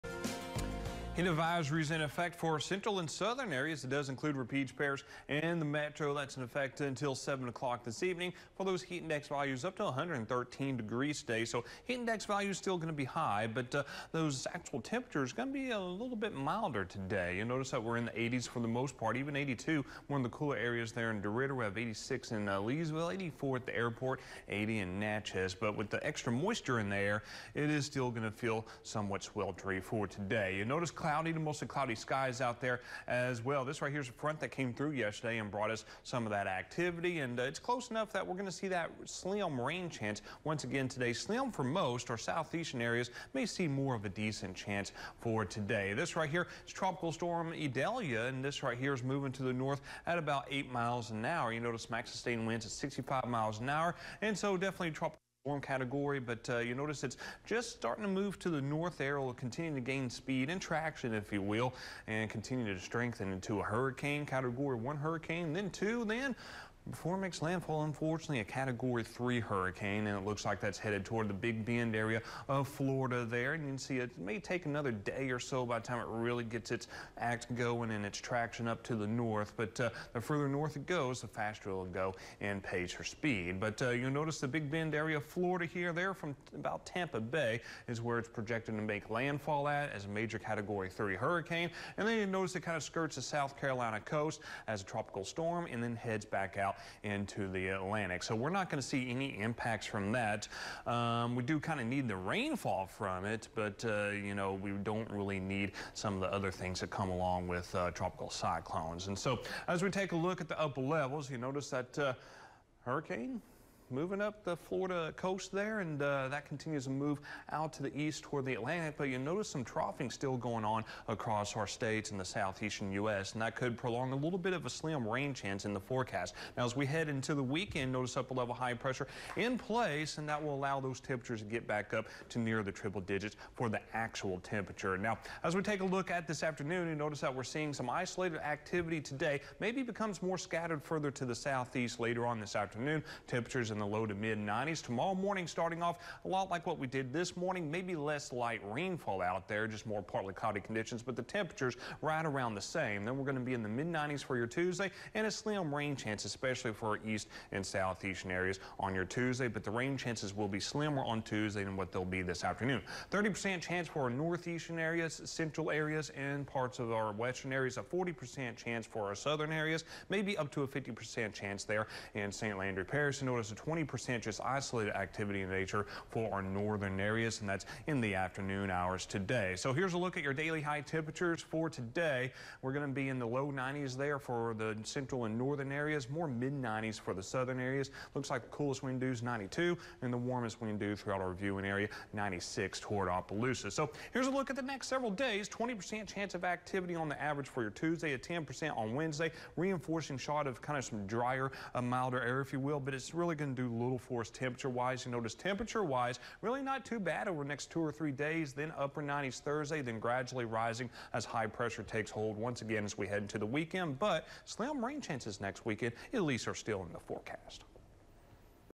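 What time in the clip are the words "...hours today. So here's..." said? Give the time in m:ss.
2:58.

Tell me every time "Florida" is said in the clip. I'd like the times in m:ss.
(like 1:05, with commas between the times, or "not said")
1:12, 1:25, 1:54.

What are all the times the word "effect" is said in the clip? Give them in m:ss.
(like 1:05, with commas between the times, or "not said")
0:02, 0:06.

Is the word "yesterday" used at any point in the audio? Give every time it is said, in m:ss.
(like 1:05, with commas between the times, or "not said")
0:34.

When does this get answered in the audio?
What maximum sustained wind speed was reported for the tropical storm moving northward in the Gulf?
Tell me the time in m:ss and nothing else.
0:52.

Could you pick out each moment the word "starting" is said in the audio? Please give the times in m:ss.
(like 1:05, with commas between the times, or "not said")
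0:57, 2:25.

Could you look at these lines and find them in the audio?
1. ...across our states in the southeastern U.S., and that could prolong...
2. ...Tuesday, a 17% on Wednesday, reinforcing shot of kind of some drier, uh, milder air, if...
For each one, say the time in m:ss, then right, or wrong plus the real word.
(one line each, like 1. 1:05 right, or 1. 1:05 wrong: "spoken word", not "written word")
1. 2:01 right
2. 3:17 wrong: "10", not "17".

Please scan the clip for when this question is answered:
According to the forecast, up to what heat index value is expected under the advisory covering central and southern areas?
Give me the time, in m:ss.
0:09.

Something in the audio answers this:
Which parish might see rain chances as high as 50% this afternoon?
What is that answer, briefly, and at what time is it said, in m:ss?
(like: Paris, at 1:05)
St. Landry Parish, at 2:52.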